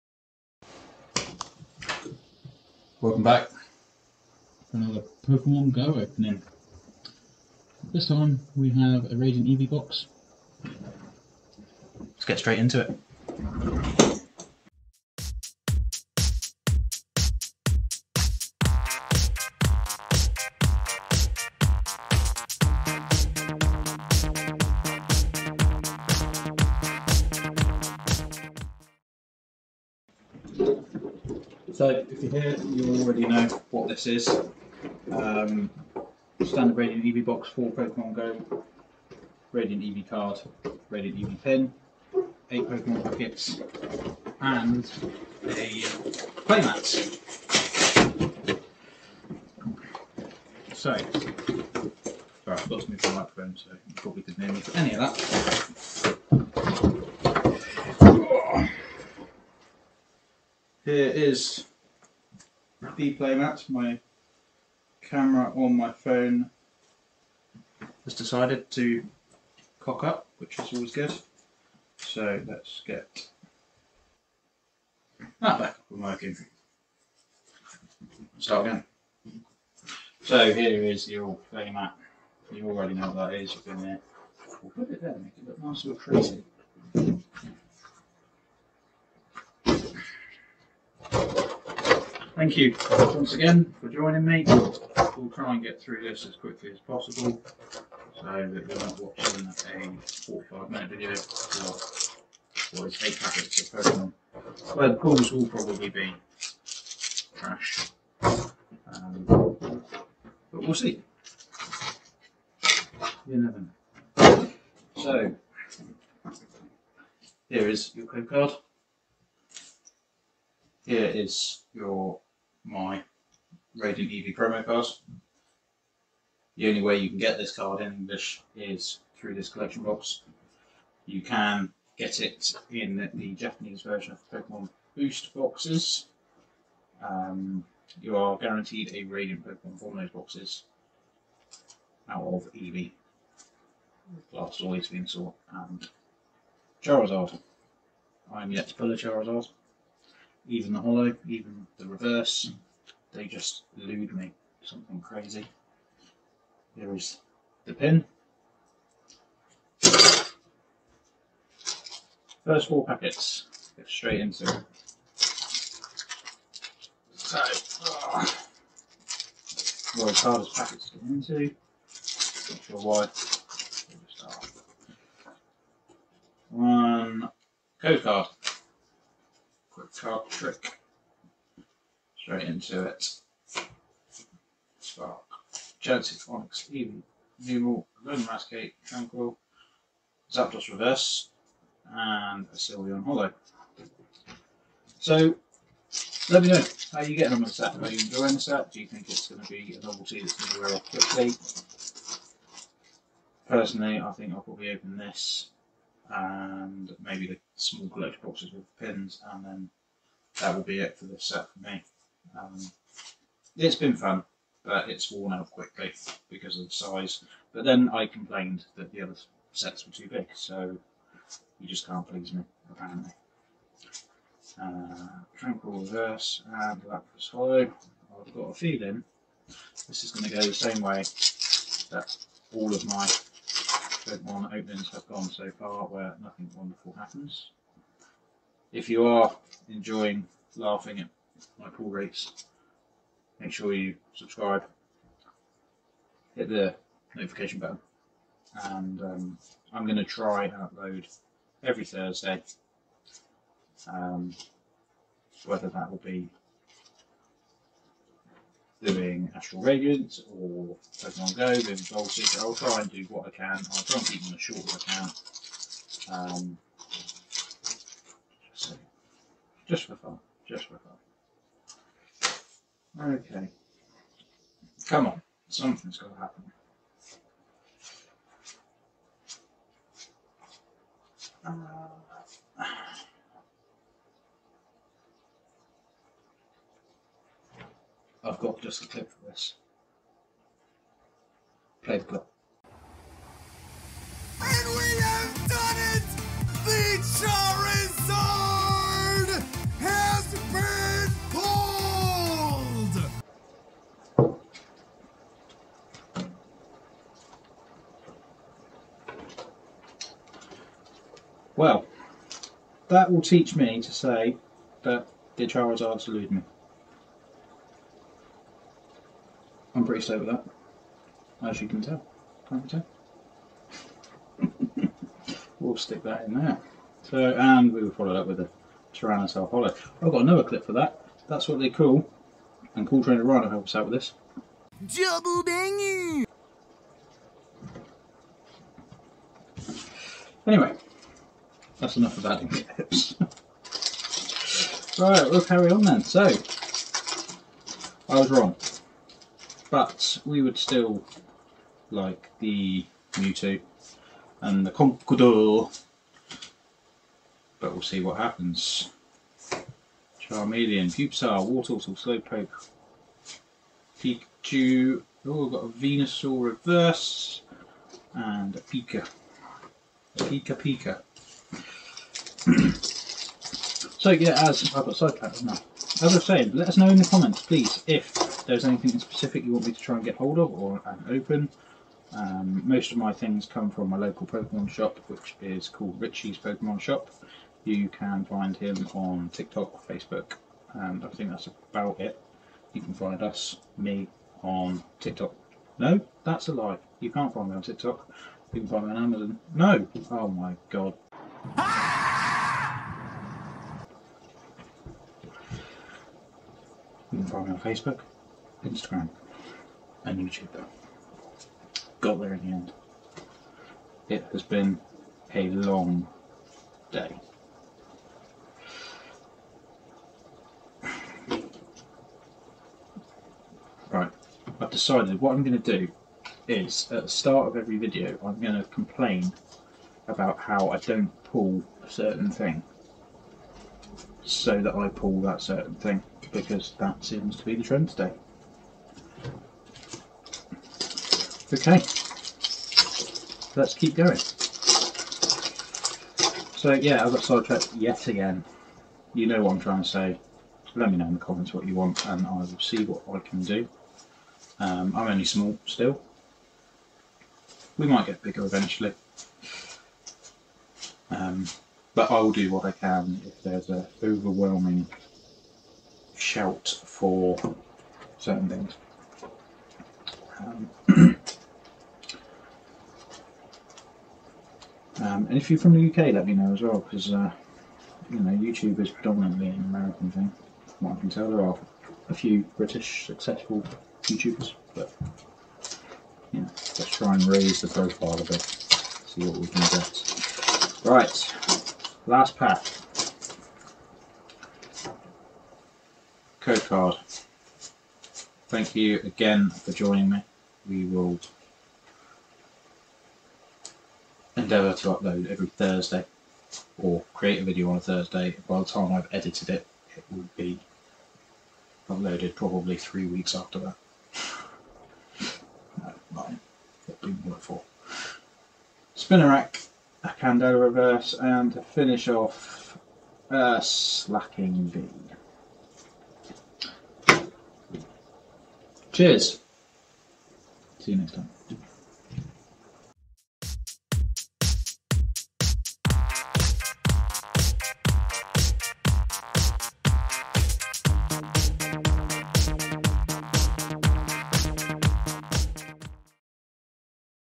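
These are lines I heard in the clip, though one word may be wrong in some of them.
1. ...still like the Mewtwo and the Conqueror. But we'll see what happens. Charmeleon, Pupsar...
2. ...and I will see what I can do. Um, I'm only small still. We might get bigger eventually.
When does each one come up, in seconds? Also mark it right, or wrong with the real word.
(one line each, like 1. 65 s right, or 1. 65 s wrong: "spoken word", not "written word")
1. 350 s right
2. 452 s right.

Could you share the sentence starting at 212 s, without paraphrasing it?
Um, it's been fun, but it's worn out quickly because of the size.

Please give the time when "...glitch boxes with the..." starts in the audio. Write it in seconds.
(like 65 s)
207 s.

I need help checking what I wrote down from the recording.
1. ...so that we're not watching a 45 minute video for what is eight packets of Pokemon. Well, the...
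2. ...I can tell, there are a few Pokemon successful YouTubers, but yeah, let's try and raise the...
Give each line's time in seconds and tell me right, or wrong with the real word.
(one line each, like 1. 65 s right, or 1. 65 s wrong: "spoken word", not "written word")
1. 98 s right
2. 480 s wrong: "British", not "Pokemon".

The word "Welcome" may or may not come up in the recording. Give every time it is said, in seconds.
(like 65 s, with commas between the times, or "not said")
3 s.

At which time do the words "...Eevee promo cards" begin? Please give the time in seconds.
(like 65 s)
124 s.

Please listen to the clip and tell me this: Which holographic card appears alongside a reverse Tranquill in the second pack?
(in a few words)
Lapras.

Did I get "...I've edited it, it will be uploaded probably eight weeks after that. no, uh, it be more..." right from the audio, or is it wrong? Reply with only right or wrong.
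wrong.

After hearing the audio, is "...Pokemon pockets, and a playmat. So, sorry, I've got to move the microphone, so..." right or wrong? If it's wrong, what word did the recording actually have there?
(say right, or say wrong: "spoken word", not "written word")
right.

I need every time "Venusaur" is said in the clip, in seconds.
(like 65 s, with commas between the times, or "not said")
144 s, 365 s.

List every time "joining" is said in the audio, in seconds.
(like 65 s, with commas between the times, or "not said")
93 s, 499 s.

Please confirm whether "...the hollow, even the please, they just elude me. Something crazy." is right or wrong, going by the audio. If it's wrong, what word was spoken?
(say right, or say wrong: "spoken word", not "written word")
wrong: "reverse", not "please".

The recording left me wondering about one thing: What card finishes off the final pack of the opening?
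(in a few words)
Slaking V.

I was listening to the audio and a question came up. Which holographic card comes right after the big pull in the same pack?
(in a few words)
Tyrannosaur.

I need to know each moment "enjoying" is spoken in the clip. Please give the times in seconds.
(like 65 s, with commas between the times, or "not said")
197 s, 239 s.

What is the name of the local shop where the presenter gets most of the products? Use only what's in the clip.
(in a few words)
Richie's Pokemon Shop.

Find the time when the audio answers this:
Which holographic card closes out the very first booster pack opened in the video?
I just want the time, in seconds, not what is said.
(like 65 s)
192 s.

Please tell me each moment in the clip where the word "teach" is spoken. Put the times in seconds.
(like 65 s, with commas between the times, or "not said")
313 s.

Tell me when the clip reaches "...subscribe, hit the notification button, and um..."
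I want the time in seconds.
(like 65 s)
244 s.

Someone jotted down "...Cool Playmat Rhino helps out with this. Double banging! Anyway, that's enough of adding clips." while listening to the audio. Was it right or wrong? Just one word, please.
wrong.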